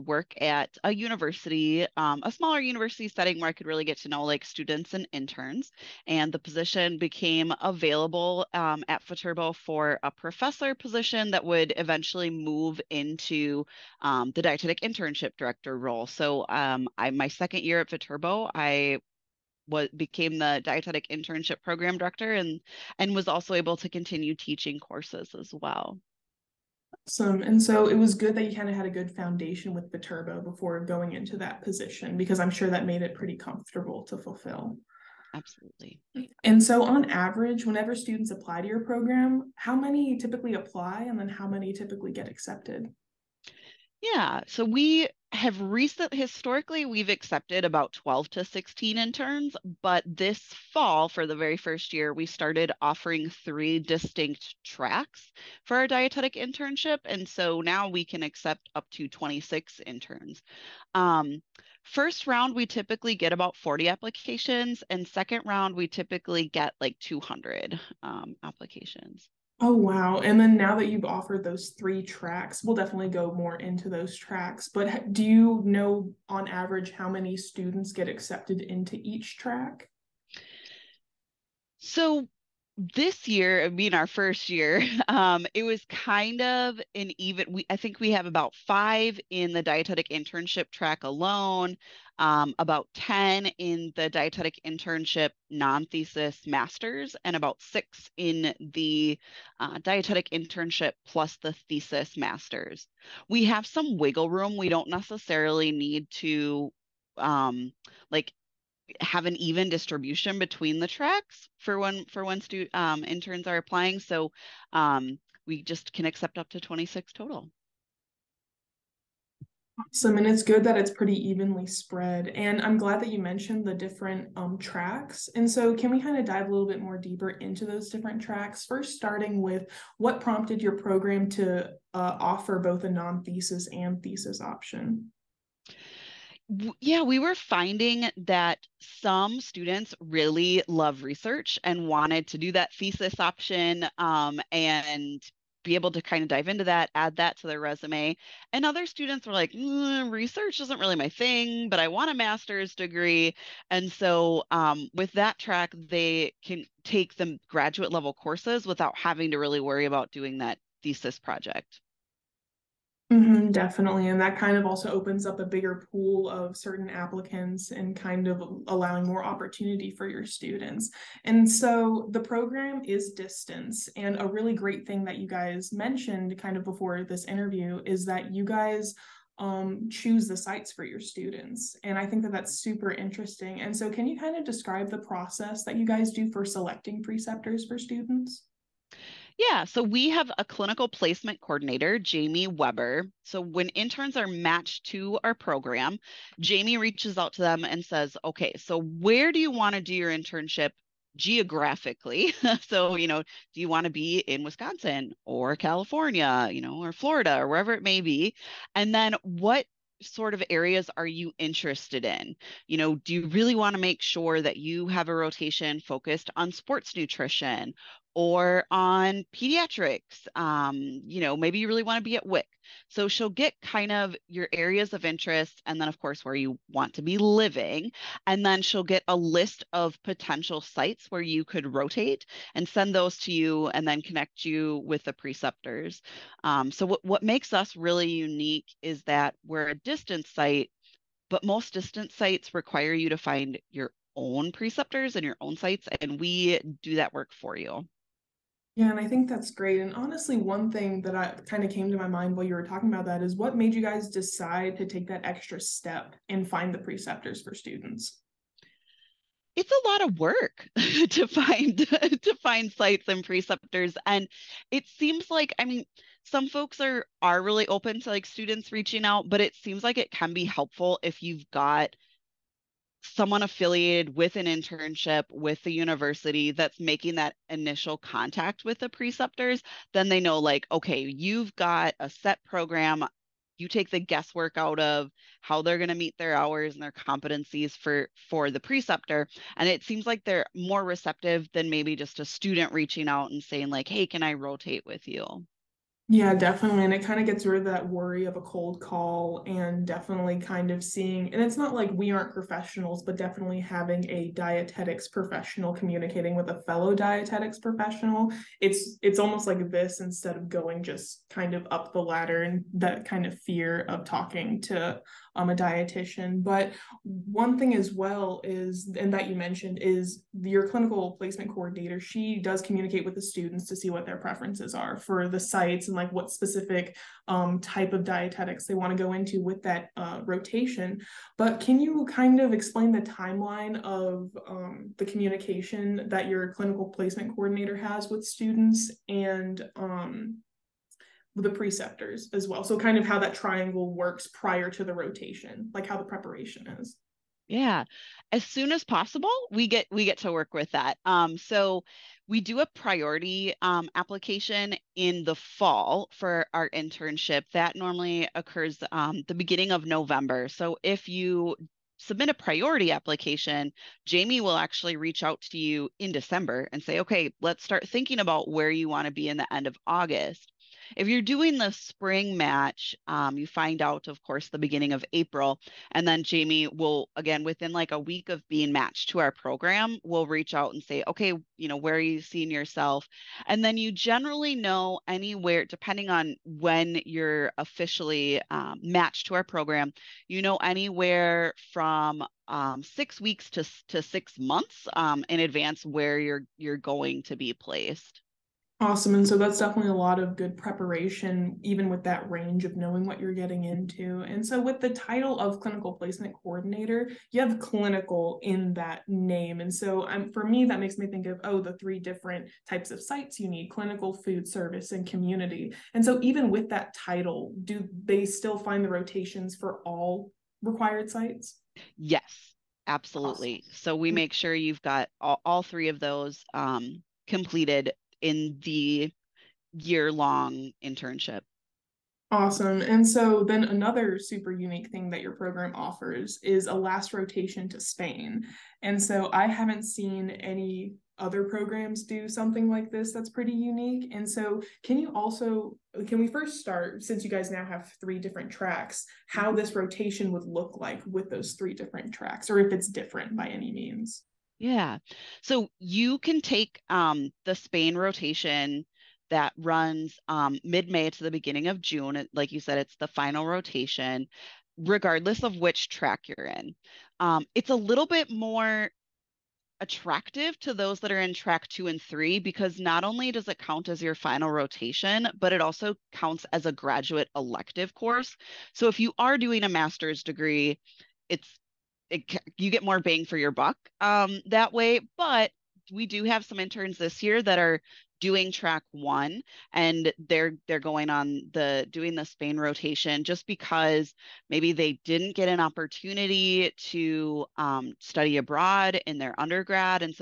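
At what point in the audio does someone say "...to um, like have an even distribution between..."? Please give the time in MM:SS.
01:46.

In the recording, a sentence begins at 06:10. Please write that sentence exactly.
If you're doing the spring match, um, you find out, of course, the beginning of April.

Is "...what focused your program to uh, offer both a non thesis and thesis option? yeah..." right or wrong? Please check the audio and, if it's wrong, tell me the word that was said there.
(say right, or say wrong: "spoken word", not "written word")
wrong: "prompted", not "focused".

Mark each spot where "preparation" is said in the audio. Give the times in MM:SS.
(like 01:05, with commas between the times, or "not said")
05:46, 06:40.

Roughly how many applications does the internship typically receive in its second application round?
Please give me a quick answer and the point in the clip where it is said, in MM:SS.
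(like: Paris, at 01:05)
200, at 01:07.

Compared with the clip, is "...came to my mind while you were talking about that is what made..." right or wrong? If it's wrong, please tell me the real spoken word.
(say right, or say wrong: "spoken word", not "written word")
right.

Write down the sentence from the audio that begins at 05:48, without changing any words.
As soon as possible, we get we get to work with that.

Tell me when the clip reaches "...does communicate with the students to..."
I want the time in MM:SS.
05:22.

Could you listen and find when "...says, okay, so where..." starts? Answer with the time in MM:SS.
03:17.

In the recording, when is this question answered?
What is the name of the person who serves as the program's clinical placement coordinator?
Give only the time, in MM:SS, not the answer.
03:11.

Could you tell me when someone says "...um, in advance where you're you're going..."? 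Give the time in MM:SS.
06:34.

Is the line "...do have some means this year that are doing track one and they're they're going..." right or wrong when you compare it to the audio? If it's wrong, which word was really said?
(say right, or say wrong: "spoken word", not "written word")
wrong: "interns", not "means".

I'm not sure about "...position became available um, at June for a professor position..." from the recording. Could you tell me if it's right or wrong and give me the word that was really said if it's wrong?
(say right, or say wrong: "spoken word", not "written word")
wrong: "Viterbo", not "June".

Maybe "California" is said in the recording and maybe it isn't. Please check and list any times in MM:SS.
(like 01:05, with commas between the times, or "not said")
03:25.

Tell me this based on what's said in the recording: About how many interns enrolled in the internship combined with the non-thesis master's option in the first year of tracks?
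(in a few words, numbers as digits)
10.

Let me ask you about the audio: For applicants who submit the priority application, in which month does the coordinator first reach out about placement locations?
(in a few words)
December.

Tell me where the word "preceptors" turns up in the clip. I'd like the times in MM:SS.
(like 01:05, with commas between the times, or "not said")
03:07, 03:55, 04:04, 04:16, 04:23, 04:38, 04:48, 05:41.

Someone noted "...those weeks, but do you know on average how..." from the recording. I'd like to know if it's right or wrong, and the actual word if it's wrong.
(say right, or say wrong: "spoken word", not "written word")
wrong: "tracks", not "weeks".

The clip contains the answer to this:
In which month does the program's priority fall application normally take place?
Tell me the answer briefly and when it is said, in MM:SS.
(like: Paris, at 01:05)
November, at 05:59.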